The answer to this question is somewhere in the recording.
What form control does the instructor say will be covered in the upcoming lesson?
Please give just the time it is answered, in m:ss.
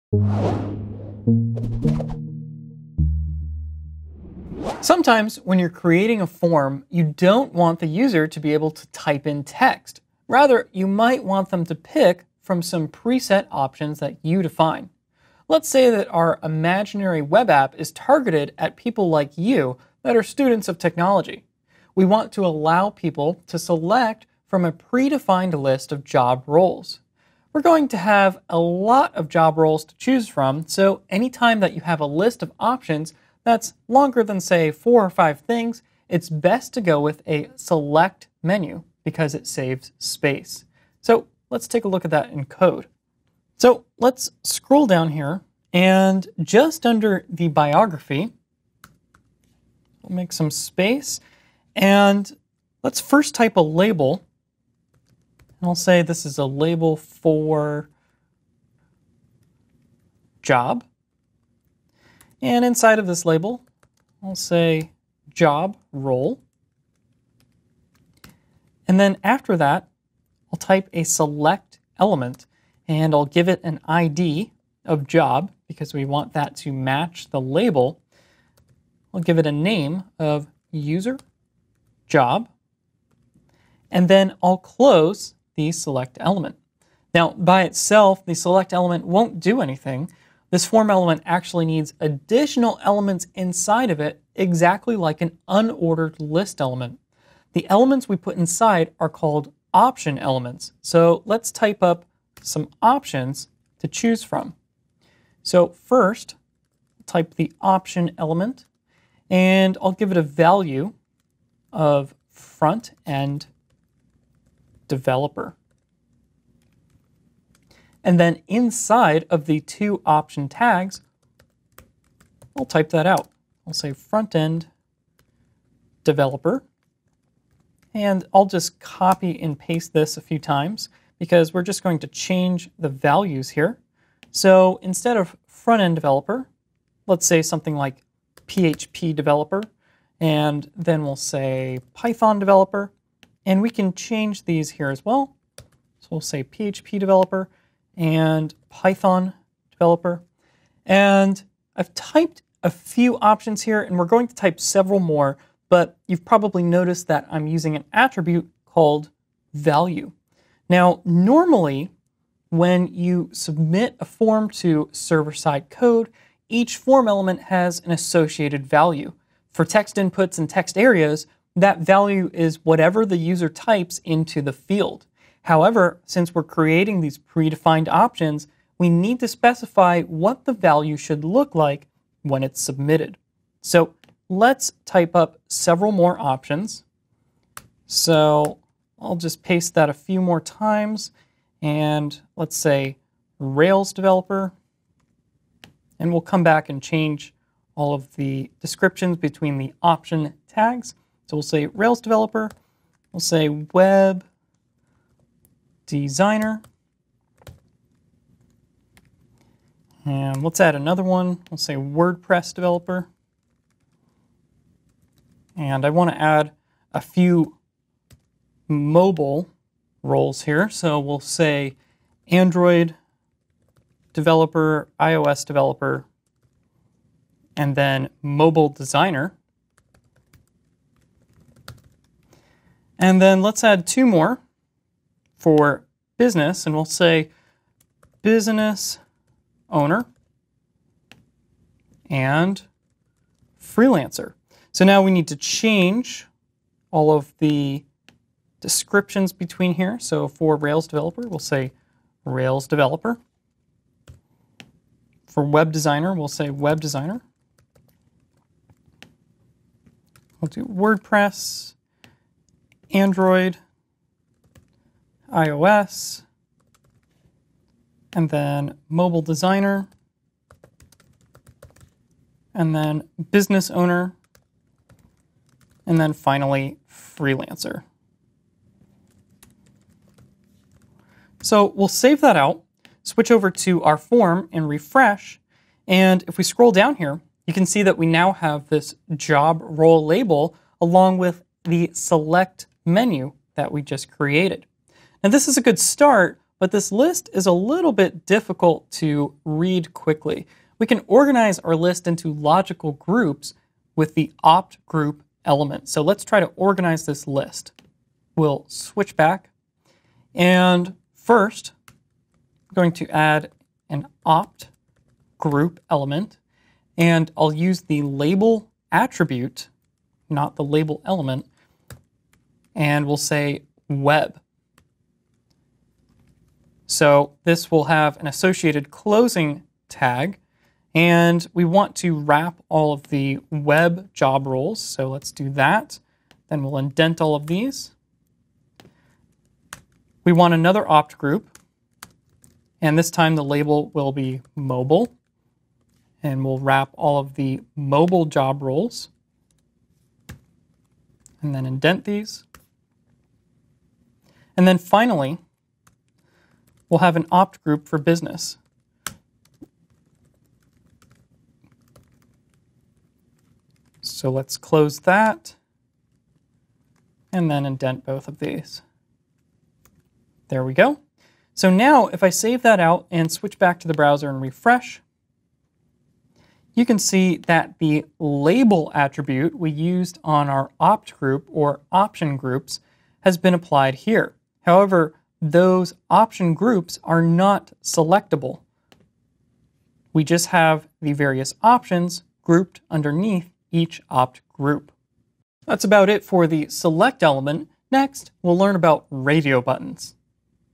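6:39.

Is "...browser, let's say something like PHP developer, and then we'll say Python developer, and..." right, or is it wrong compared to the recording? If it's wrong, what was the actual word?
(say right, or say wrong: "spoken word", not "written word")
wrong: "developer", not "browser".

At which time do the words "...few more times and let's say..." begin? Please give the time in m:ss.
3:09.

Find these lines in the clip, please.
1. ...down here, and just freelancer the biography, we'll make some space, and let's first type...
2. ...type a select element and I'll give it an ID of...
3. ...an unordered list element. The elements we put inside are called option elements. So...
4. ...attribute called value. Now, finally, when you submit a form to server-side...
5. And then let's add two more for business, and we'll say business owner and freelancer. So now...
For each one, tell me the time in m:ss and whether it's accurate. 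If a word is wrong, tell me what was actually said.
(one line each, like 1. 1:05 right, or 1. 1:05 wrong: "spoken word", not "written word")
1. 0:44 wrong: "under", not "freelancer"
2. 1:10 right
3. 1:35 right
4. 2:37 wrong: "normally", not "finally"
5. 3:53 right.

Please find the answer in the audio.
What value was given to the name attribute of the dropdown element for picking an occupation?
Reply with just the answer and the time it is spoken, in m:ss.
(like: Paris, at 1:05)
user job, at 1:20.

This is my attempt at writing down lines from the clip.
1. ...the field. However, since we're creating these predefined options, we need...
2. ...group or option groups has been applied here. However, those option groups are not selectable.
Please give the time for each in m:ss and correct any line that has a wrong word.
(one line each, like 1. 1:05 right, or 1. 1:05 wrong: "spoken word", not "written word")
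1. 2:54 right
2. 6:21 right.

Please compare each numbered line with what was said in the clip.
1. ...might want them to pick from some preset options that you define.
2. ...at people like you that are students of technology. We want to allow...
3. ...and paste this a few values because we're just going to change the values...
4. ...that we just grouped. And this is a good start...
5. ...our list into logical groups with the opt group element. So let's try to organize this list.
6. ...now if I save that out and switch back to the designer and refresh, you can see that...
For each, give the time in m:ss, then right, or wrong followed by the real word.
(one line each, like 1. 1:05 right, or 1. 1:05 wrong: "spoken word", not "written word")
1. 0:10 right
2. 0:18 right
3. 2:09 wrong: "times", not "values"
4. 4:53 wrong: "created", not "grouped"
5. 5:01 right
6. 6:11 wrong: "browser", not "designer".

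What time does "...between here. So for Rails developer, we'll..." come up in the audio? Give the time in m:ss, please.
4:09.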